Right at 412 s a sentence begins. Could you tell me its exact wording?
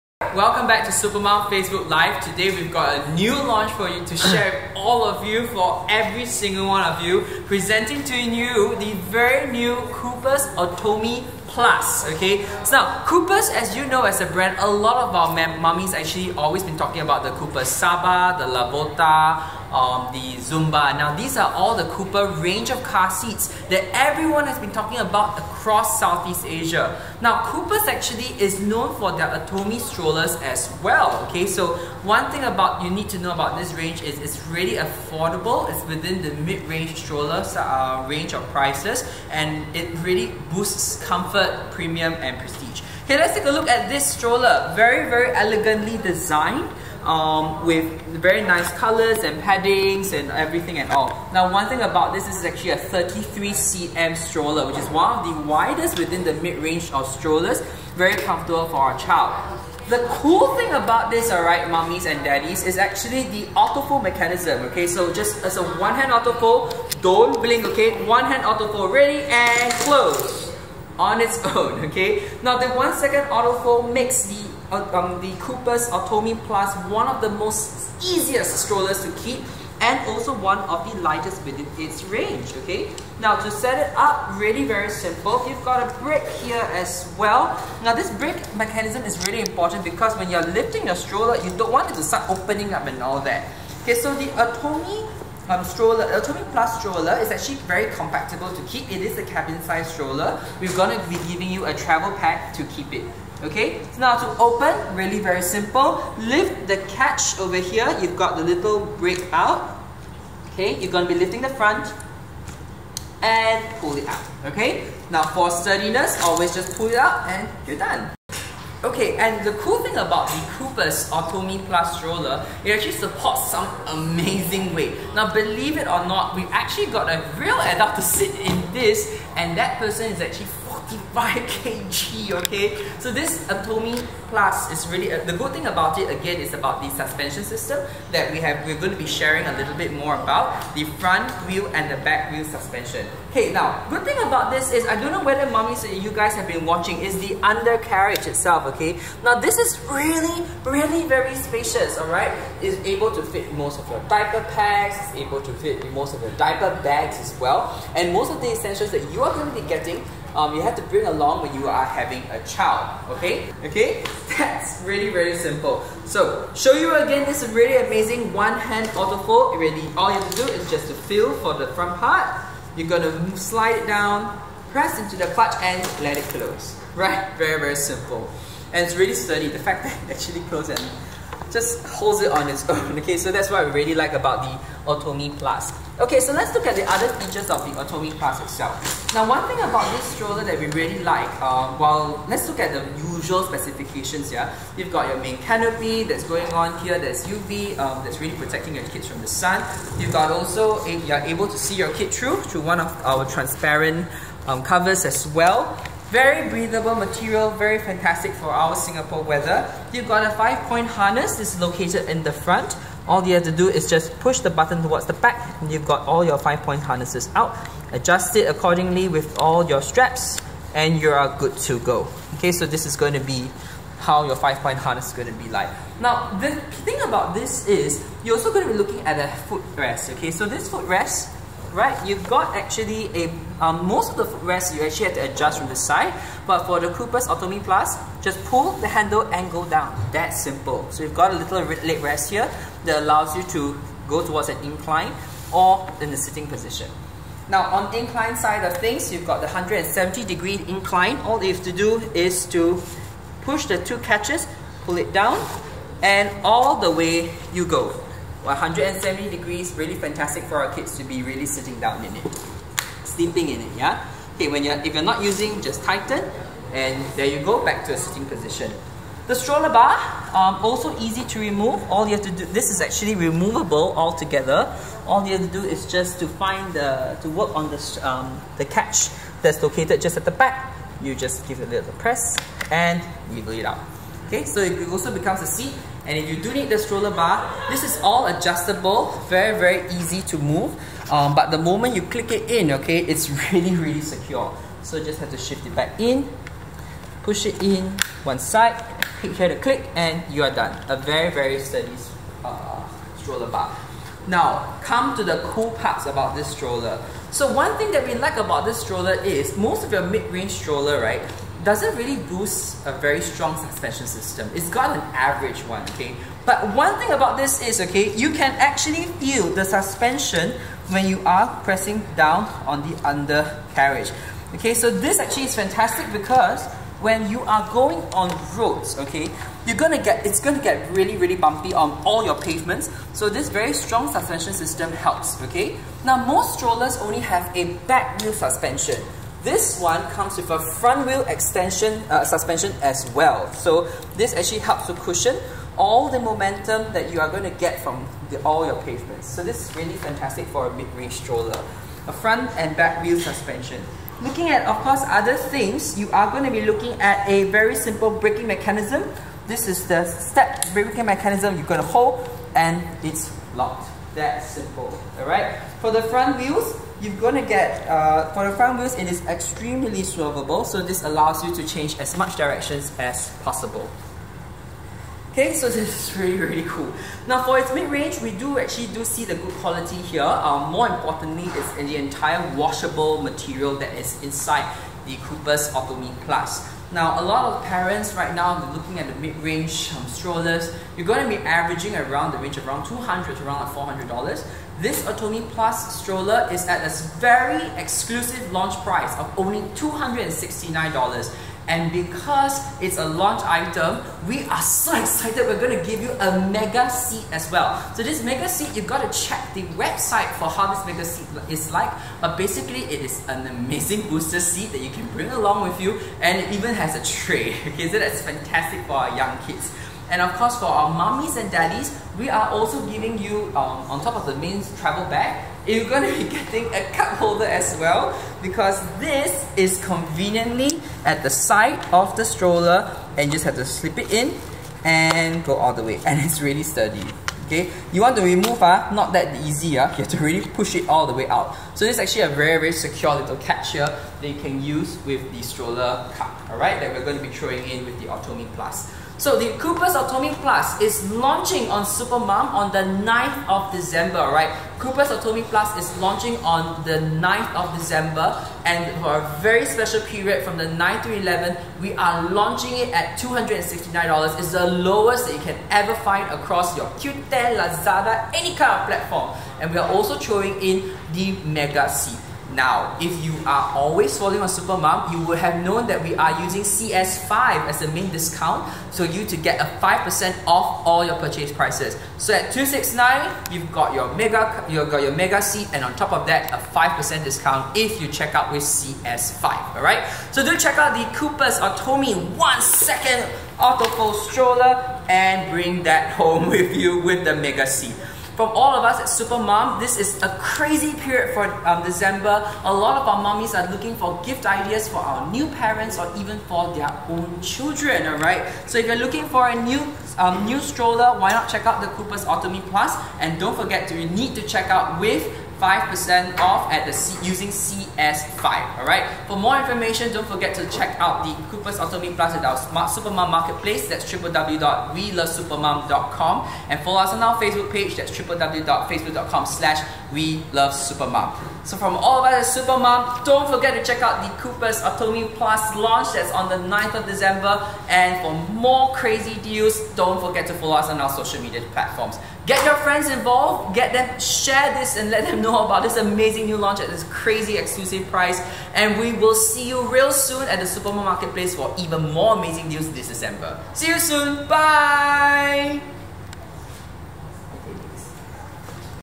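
But basically, it is an amazing booster seat that you can bring along with you.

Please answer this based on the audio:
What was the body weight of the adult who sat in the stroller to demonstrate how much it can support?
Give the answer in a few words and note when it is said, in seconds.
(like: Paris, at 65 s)
65 kg, at 130 s.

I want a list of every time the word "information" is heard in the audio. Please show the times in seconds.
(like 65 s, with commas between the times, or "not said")
519 s.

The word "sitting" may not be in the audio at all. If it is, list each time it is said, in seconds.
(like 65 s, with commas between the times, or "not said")
246 s, 261 s, 267 s.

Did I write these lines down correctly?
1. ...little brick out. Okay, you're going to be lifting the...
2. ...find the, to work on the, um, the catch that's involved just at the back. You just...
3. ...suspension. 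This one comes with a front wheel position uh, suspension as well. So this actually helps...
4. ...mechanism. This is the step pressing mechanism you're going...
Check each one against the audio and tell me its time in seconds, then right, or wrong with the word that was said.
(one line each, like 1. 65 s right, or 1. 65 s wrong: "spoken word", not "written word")
1. 108 s right
2. 276 s wrong: "located", not "involved"
3. 338 s wrong: "extension", not "position"
4. 358 s wrong: "braking", not "pressing".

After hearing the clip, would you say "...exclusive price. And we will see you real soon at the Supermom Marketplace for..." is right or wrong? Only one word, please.
right.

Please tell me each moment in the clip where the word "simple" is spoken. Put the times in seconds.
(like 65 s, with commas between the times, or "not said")
84 s, 105 s, 165 s, 177 s, 240 s, 357 s, 364 s.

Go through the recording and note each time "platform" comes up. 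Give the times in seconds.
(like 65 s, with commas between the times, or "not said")
468 s, 541 s.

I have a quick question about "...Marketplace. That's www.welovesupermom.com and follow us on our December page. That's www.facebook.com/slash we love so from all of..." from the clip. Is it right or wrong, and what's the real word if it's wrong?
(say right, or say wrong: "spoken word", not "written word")
wrong: "Facebook", not "December".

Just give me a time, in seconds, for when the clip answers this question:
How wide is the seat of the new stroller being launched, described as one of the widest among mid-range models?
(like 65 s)
52 s.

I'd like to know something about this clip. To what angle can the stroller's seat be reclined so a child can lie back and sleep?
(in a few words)
170 degrees.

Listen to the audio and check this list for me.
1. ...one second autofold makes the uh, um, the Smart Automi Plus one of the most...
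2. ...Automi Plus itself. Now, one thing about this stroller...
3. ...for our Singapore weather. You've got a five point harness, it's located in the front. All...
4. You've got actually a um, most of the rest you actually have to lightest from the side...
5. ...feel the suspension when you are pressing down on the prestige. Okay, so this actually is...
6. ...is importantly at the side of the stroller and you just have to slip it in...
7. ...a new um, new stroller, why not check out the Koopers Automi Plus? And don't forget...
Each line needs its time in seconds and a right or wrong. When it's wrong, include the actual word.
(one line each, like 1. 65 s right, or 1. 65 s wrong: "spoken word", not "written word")
1. 72 s wrong: "Koopers", not "Smart"
2. 187 s right
3. 208 s right
4. 232 s wrong: "adjust", not "lightest"
5. 319 s wrong: "undercarriage", not "prestige"
6. 429 s wrong: "conveniently", not "importantly"
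7. 509 s right.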